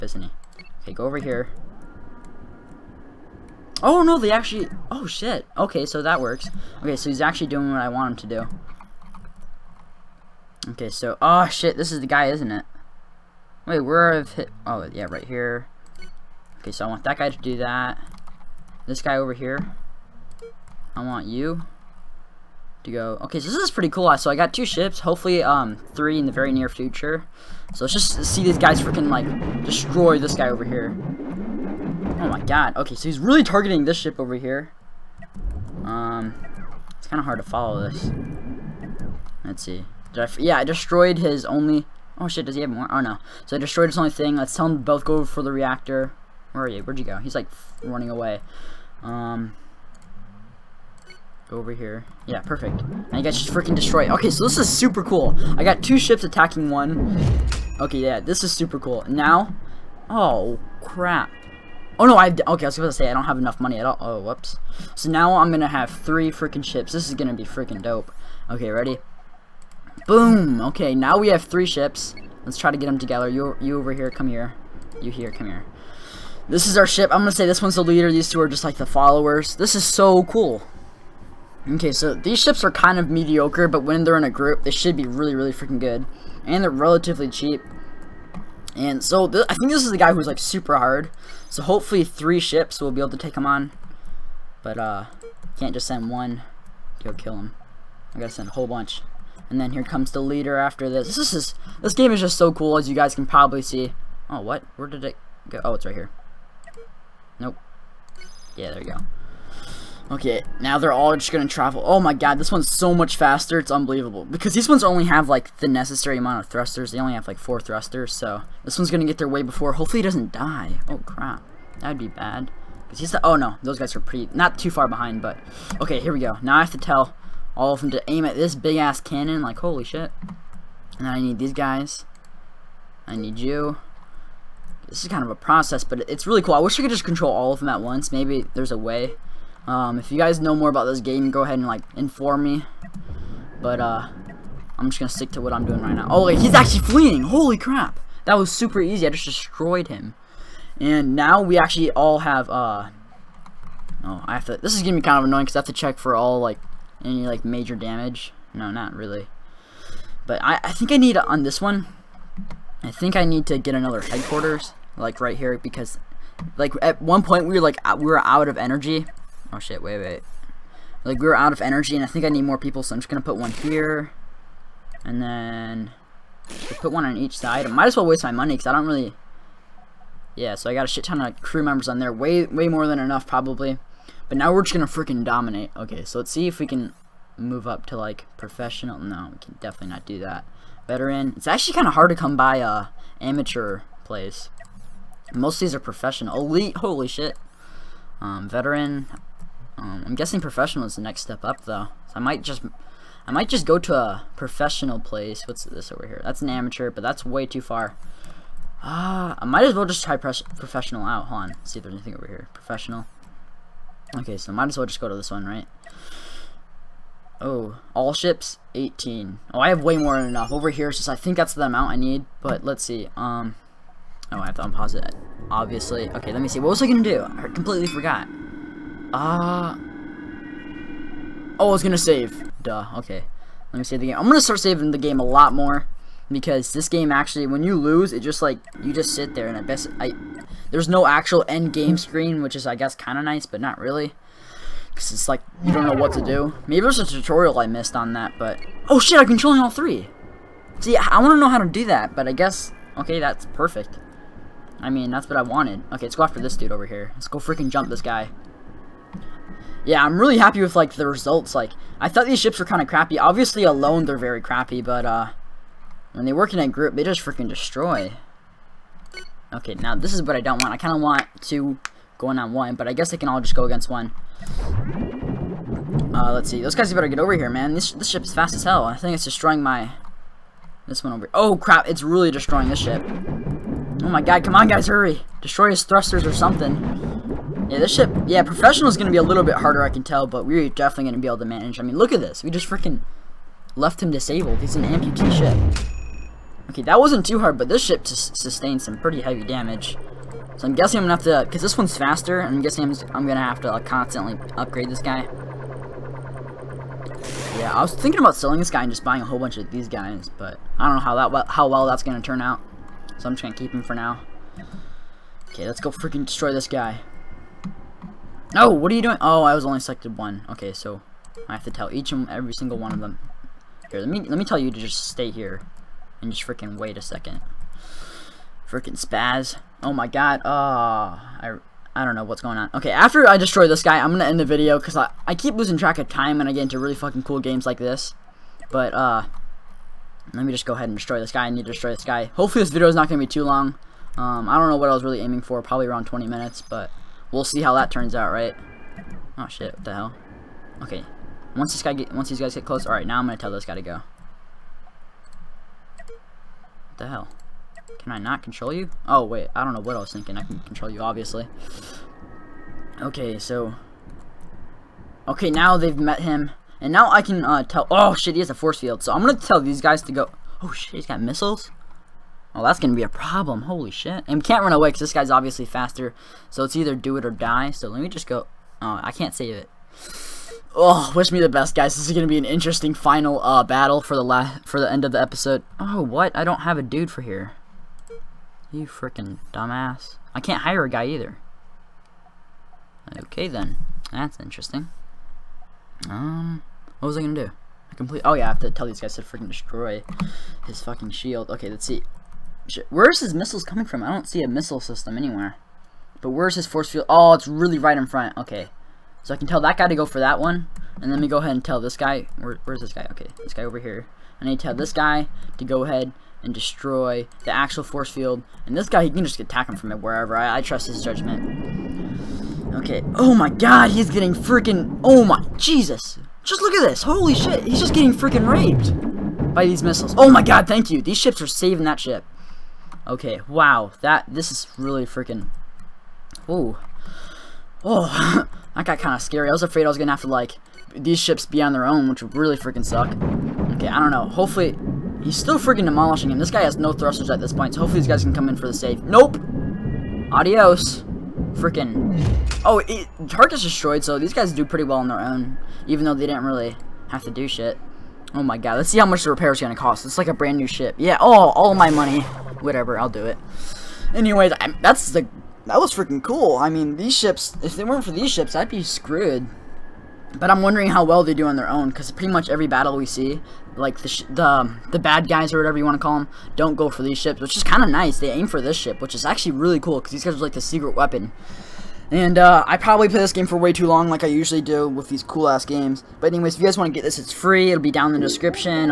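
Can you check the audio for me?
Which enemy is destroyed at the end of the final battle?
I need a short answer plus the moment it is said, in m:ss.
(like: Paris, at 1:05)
Tarkus, at 7:33.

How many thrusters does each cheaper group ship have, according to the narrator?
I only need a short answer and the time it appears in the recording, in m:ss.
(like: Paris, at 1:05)
4, at 1:57.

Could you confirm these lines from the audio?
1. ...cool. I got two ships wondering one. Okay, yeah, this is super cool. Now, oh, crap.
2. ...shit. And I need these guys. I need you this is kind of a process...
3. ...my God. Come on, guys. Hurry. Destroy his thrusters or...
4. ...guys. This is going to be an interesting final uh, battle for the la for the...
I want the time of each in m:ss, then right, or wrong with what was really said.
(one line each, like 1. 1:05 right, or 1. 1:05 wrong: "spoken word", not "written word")
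1. 0:55 wrong: "attacking", not "wondering"
2. 2:09 right
3. 4:44 right
4. 6:21 right.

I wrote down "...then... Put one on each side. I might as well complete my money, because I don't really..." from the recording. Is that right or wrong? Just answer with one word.
wrong.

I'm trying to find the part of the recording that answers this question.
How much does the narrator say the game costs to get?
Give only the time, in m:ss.
8:07.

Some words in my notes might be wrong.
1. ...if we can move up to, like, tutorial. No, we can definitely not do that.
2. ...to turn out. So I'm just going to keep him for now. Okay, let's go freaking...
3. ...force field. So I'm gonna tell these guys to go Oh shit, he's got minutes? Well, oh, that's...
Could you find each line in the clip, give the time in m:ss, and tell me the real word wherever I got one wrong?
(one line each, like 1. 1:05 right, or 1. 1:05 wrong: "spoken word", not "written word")
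1. 3:06 wrong: "professional", not "tutorial"
2. 5:12 right
3. 6:08 wrong: "missiles", not "minutes".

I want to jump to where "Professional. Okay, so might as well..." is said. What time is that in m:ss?
3:32.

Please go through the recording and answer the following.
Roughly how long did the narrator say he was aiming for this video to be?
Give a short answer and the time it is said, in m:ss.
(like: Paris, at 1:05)
20 minutes, at 5:46.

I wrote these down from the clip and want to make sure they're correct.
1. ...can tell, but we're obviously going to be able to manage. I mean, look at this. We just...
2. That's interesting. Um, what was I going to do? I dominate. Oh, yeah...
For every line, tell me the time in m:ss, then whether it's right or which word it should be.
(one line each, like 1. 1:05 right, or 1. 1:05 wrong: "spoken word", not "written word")
1. 4:49 wrong: "definitely", not "obviously"
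2. 6:34 wrong: "complete", not "dominate".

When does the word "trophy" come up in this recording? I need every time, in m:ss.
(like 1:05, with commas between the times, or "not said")
not said.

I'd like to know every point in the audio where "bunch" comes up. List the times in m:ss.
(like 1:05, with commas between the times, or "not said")
1:38, 5:09.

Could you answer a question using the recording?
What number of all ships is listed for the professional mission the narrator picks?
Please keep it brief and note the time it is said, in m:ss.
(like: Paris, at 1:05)
18, at 3:38.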